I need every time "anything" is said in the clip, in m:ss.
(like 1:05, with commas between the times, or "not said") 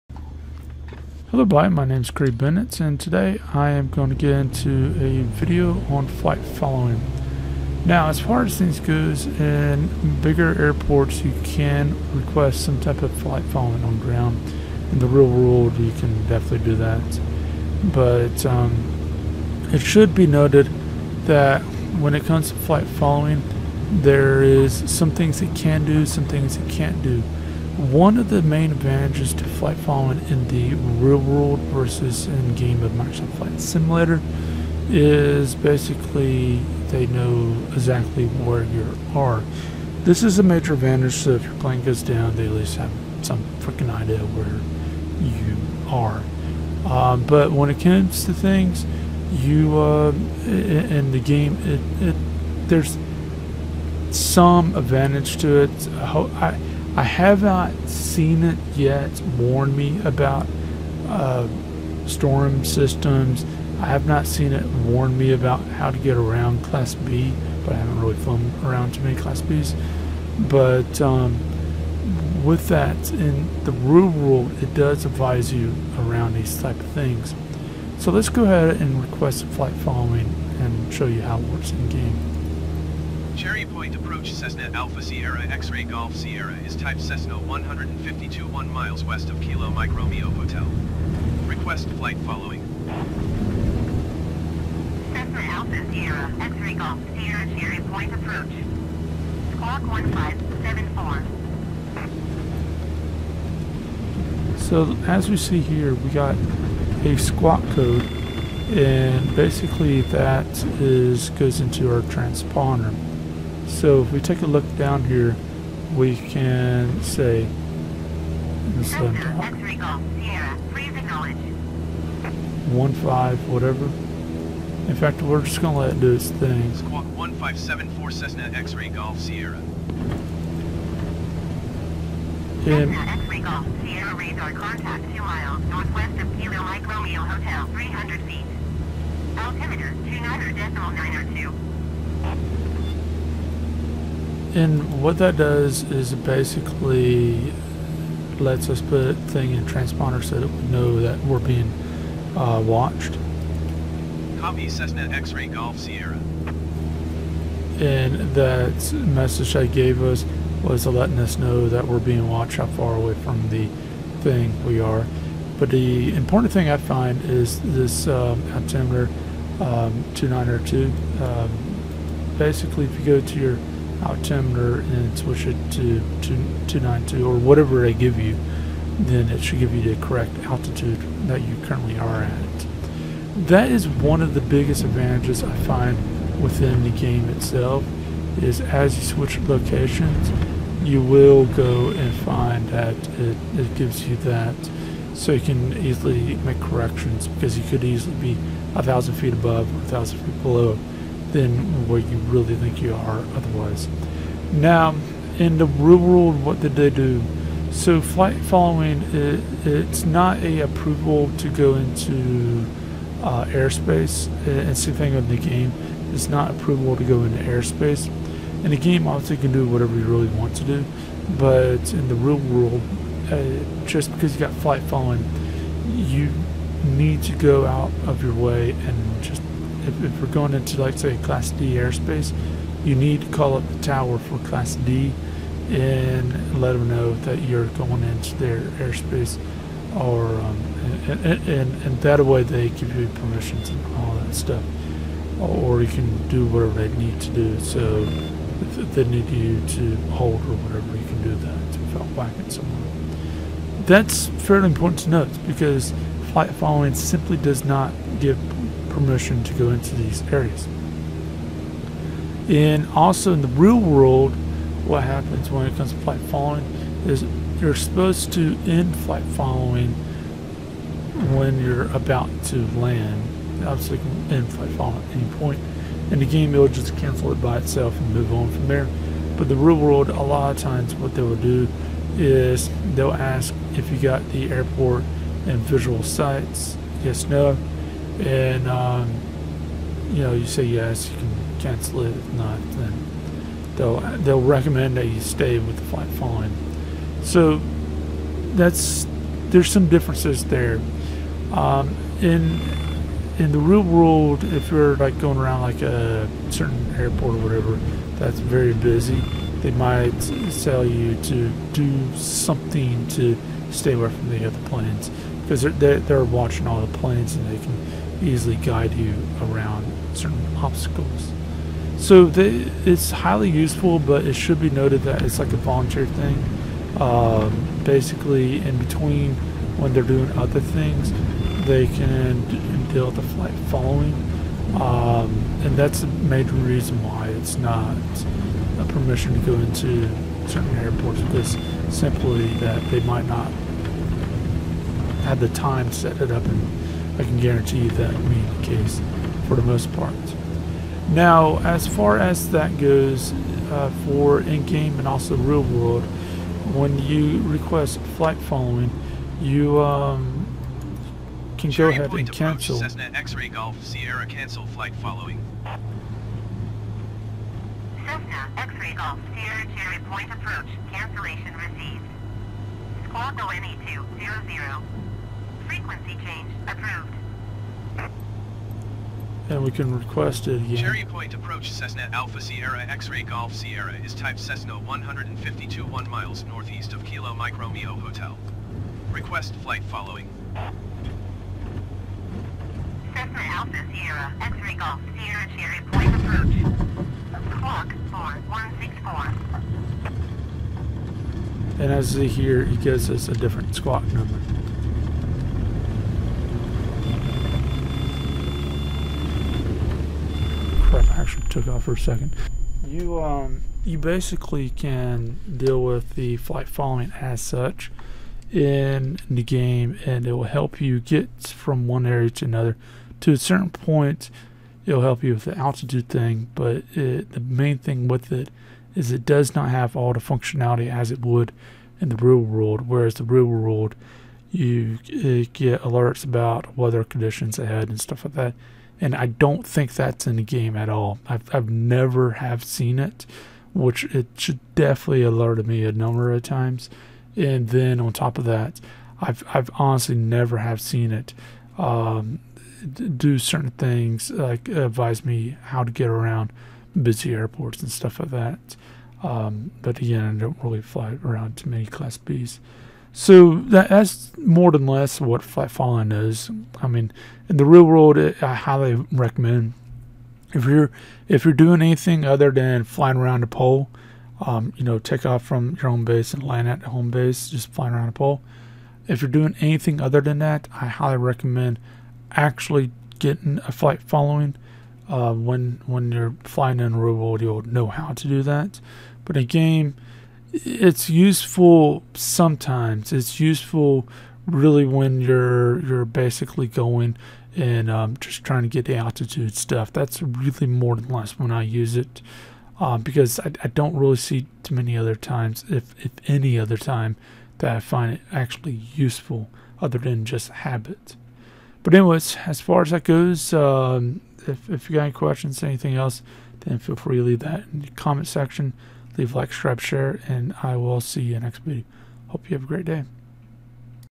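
7:51, 7:59, 8:35.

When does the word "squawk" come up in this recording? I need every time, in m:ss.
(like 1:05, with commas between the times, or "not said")
1:39, 1:47, 2:06, 6:13, 6:37, 6:43.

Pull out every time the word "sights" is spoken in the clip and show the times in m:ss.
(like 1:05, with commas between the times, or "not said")
4:46.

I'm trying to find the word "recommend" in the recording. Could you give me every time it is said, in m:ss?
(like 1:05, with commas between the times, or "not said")
4:54, 7:49, 8:01.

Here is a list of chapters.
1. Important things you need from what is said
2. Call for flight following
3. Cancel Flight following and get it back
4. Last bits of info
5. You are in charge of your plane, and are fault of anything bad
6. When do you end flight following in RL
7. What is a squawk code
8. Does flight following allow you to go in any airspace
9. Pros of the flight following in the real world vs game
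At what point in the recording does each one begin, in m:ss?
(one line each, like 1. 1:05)
1. 2:30
2. 1:20
3. 5:58
4. 6:50
5. 5:20
6. 4:20
7. 1:40
8. 3:20
9. 0:20.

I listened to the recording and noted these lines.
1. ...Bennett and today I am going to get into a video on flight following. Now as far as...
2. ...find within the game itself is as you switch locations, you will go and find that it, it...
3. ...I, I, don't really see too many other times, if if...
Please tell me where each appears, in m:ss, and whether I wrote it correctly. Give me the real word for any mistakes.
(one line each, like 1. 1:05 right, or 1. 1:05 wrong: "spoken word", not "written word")
1. 0:02 right
2. 3:05 right
3. 8:23 right.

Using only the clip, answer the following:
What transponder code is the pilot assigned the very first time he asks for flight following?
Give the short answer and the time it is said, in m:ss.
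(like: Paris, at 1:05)
1574, at 1:39.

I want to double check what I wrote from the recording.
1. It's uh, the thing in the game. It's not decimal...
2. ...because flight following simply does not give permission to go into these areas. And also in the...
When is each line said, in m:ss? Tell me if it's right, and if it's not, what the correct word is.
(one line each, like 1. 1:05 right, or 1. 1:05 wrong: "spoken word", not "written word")
1. 3:34 wrong: "approval", not "decimal"
2. 4:15 right.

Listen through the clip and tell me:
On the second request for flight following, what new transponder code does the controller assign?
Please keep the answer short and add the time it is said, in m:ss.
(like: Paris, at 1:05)
4164, at 6:38.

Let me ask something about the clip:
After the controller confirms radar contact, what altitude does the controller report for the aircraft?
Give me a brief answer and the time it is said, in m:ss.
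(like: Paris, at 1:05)
300 feet, at 2:17.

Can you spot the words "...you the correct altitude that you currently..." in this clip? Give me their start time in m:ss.
2:59.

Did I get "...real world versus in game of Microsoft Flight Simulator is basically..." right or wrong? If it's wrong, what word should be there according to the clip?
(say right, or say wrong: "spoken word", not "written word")
right.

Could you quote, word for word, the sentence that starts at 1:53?
So if we take a look down here, we can say this one five whatever.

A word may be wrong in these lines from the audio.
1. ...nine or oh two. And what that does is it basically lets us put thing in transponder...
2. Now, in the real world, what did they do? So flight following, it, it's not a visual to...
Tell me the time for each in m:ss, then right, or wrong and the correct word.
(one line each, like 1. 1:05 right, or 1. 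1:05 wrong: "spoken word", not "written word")
1. 2:20 right
2. 3:24 wrong: "approval", not "visual".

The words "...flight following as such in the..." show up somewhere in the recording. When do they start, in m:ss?
6:56.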